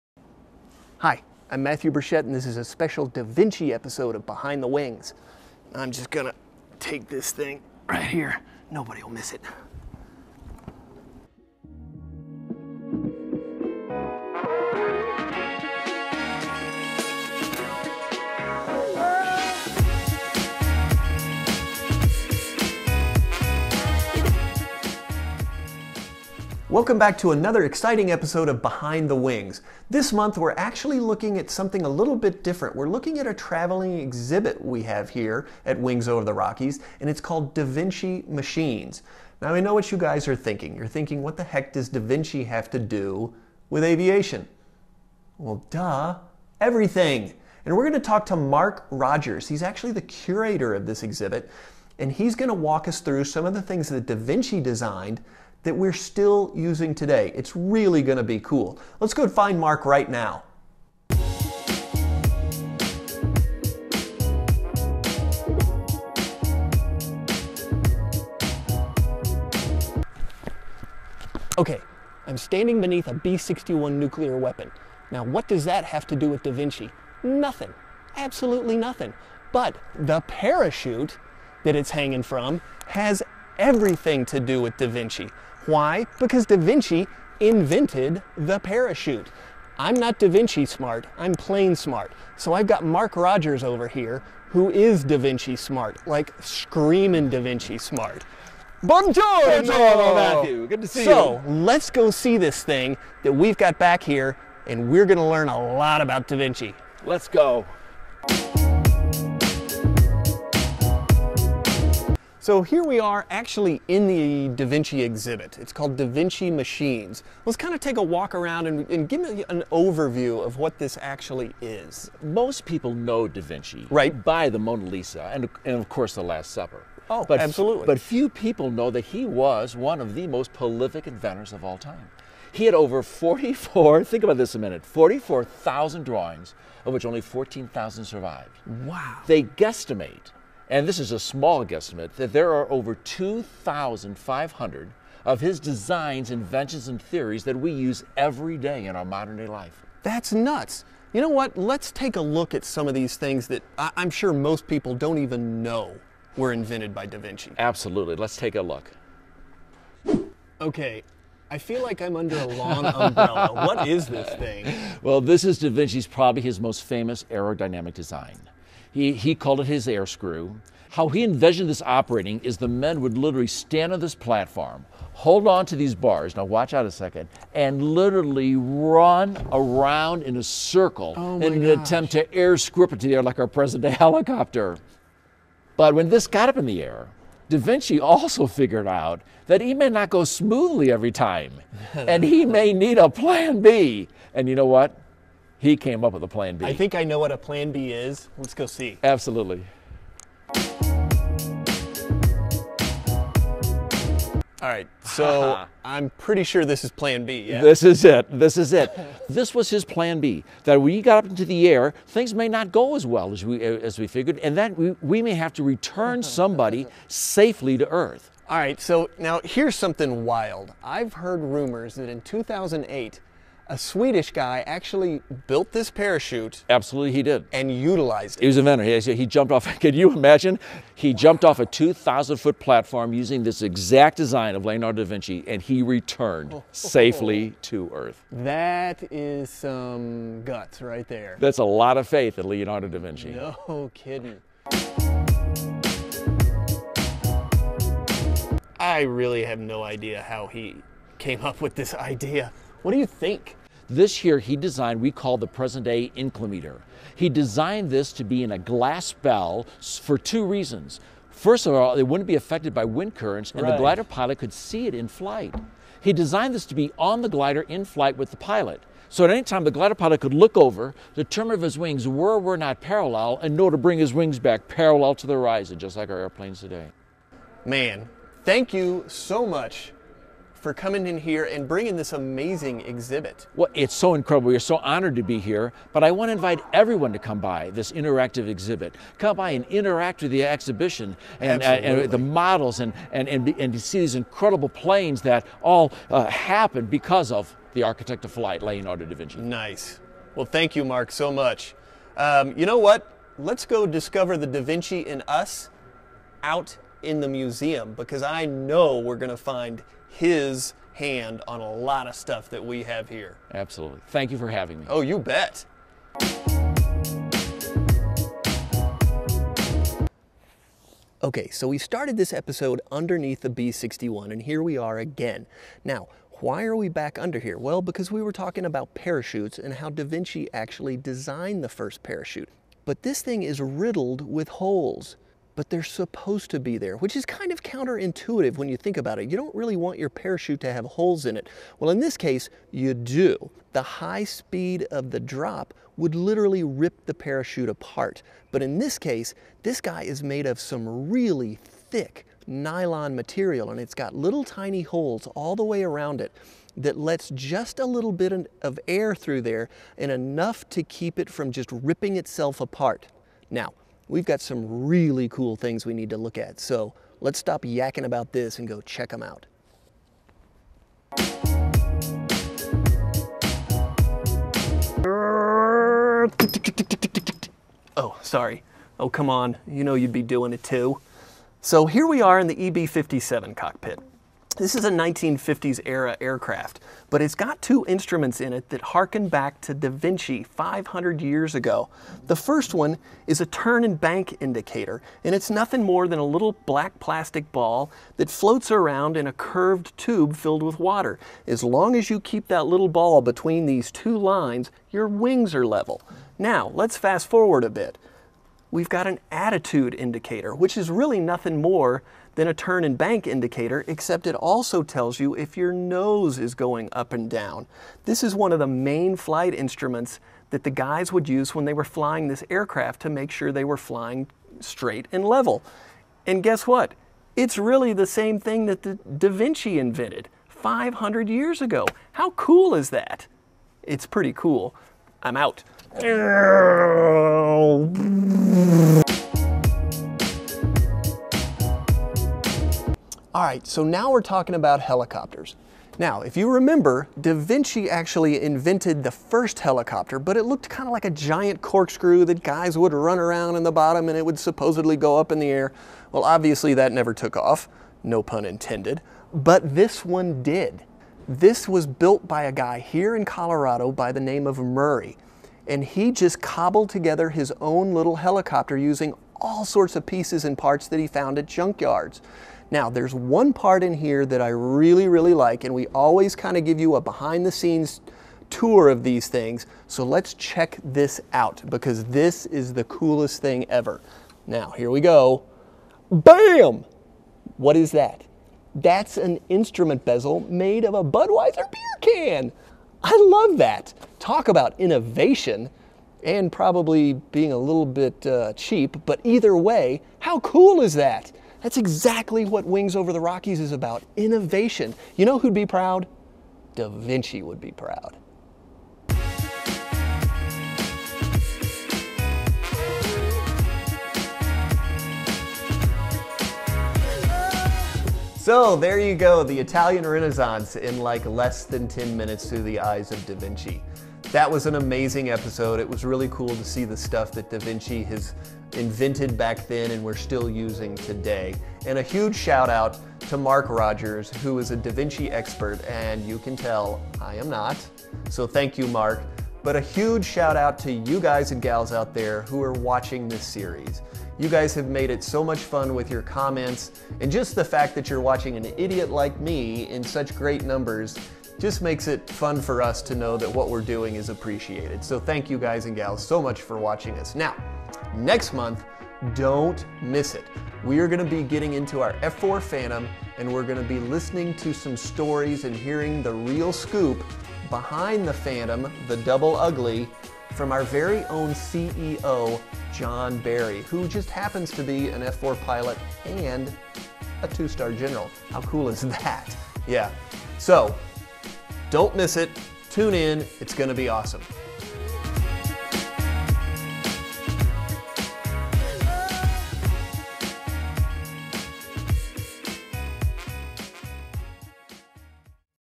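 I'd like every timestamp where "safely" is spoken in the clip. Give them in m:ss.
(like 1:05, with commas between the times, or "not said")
3:37, 3:56.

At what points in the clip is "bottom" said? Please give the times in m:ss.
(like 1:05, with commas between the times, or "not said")
7:33.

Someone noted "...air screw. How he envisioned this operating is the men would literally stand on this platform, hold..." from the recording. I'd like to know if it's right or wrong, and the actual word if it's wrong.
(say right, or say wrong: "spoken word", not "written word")
right.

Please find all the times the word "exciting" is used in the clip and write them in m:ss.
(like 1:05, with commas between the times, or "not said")
0:27.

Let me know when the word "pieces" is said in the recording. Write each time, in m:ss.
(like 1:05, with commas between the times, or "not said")
7:50.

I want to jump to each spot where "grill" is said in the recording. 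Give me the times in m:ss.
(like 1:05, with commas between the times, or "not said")
not said.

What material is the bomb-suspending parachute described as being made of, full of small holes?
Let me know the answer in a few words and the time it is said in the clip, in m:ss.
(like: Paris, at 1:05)
thick nylon, at 5:51.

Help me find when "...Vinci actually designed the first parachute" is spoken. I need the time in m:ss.
5:30.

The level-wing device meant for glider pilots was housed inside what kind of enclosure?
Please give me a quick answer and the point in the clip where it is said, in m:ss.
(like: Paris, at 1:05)
glass bell, at 4:18.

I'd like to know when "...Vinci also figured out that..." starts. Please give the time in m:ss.
3:07.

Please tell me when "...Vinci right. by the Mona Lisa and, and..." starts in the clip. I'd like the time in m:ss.
2:03.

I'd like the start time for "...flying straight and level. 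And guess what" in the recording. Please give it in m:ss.
7:03.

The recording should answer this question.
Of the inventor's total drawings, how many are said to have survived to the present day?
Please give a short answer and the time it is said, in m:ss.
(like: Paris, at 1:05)
14,000, at 2:17.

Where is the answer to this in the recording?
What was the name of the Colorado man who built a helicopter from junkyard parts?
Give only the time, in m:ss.
7:44.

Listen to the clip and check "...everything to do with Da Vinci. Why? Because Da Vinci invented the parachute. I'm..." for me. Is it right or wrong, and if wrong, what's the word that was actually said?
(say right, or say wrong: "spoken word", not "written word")
right.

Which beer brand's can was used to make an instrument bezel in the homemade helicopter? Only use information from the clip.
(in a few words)
Budweiser.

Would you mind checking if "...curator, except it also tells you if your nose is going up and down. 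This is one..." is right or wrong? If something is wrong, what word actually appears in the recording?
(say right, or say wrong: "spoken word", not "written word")
wrong: "indicator", not "curator".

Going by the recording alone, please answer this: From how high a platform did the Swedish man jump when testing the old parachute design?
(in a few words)
2,000 foot.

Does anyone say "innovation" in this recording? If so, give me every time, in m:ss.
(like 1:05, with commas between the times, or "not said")
8:14, 8:24.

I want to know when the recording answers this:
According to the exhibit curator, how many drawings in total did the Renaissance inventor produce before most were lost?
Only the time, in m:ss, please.
2:14.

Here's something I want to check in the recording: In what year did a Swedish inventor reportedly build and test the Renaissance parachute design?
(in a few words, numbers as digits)
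2008.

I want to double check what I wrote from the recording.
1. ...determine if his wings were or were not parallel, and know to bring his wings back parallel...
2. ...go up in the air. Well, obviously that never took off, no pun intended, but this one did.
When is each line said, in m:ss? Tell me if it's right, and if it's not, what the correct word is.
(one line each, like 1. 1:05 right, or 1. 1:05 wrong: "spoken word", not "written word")
1. 4:31 right
2. 7:34 right.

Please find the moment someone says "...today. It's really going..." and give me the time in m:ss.
0:56.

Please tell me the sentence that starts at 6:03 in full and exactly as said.
Now, we've got some really cool things we need to look at.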